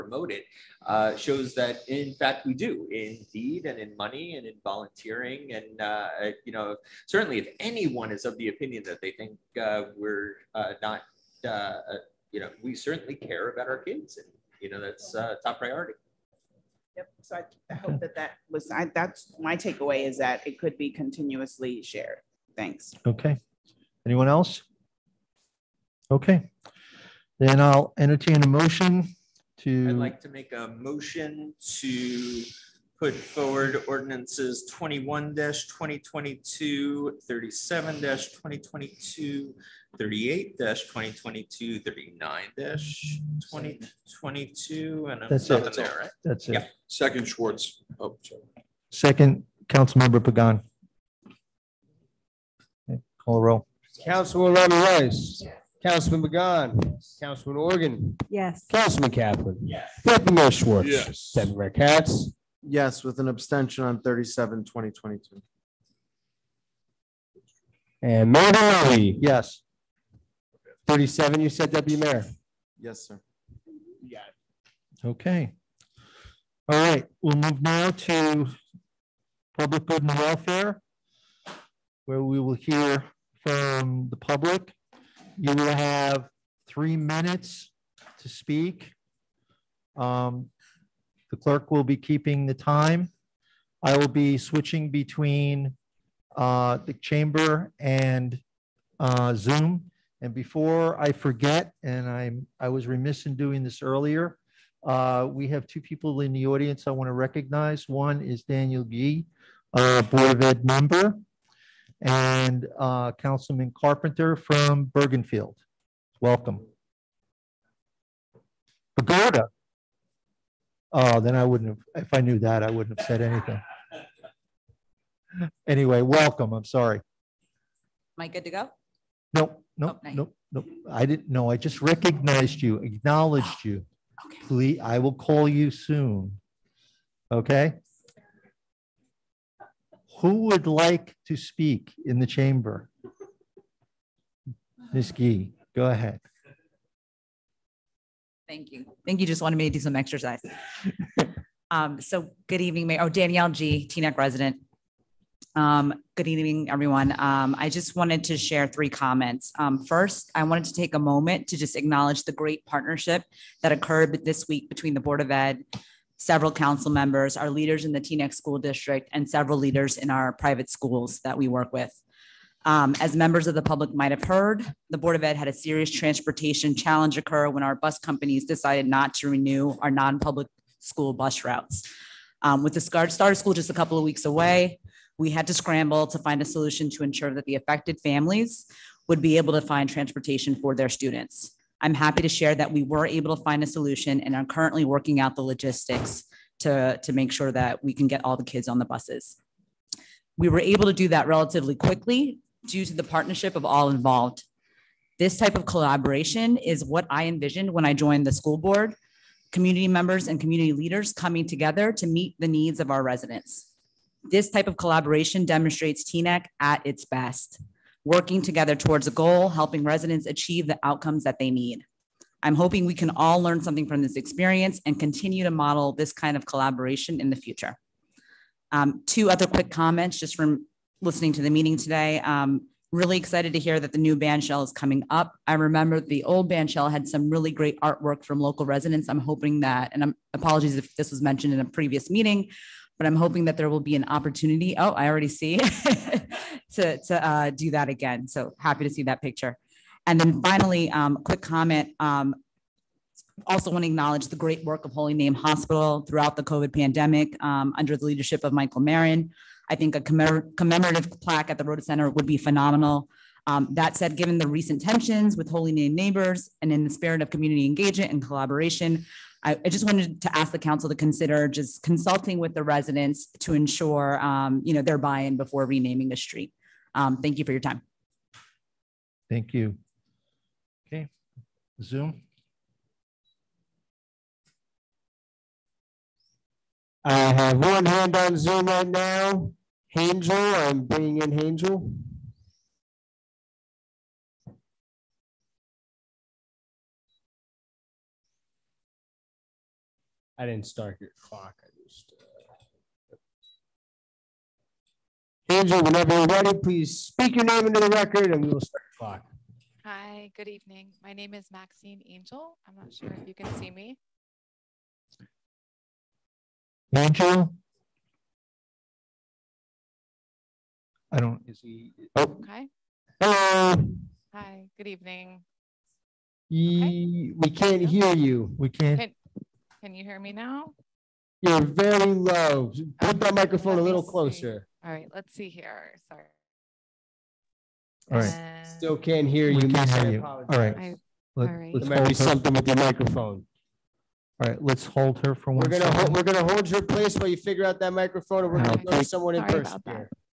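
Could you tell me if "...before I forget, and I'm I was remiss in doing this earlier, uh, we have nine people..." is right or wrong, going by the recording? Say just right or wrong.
wrong.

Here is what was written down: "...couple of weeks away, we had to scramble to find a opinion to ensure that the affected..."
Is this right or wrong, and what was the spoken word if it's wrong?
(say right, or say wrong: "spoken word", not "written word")
wrong: "solution", not "opinion".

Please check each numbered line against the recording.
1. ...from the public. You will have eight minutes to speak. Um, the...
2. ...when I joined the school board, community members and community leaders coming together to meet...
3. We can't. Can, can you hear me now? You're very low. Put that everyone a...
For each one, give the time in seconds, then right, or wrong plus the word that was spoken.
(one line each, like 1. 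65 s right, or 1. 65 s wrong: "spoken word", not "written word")
1. 83 s wrong: "three", not "eight"
2. 207 s right
3. 328 s wrong: "microphone", not "everyone".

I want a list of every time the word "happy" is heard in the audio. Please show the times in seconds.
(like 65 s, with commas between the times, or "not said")
191 s, 248 s.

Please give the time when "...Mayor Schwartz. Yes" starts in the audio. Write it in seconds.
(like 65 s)
60 s.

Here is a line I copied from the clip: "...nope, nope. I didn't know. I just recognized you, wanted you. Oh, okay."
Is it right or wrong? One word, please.
wrong.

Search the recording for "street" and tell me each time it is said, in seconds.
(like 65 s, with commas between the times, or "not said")
276 s.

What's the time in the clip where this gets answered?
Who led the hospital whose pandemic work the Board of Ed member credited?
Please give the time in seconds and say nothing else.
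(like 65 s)
258 s.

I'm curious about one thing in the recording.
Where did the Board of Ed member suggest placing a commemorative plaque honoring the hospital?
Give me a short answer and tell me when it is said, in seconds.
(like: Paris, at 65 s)
Rodda Center, at 261 s.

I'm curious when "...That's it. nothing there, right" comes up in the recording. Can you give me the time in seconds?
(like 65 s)
45 s.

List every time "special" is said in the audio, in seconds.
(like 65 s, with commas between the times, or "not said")
not said.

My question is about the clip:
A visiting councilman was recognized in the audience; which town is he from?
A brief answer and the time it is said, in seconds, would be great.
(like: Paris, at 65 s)
Bergenfield, at 114 s.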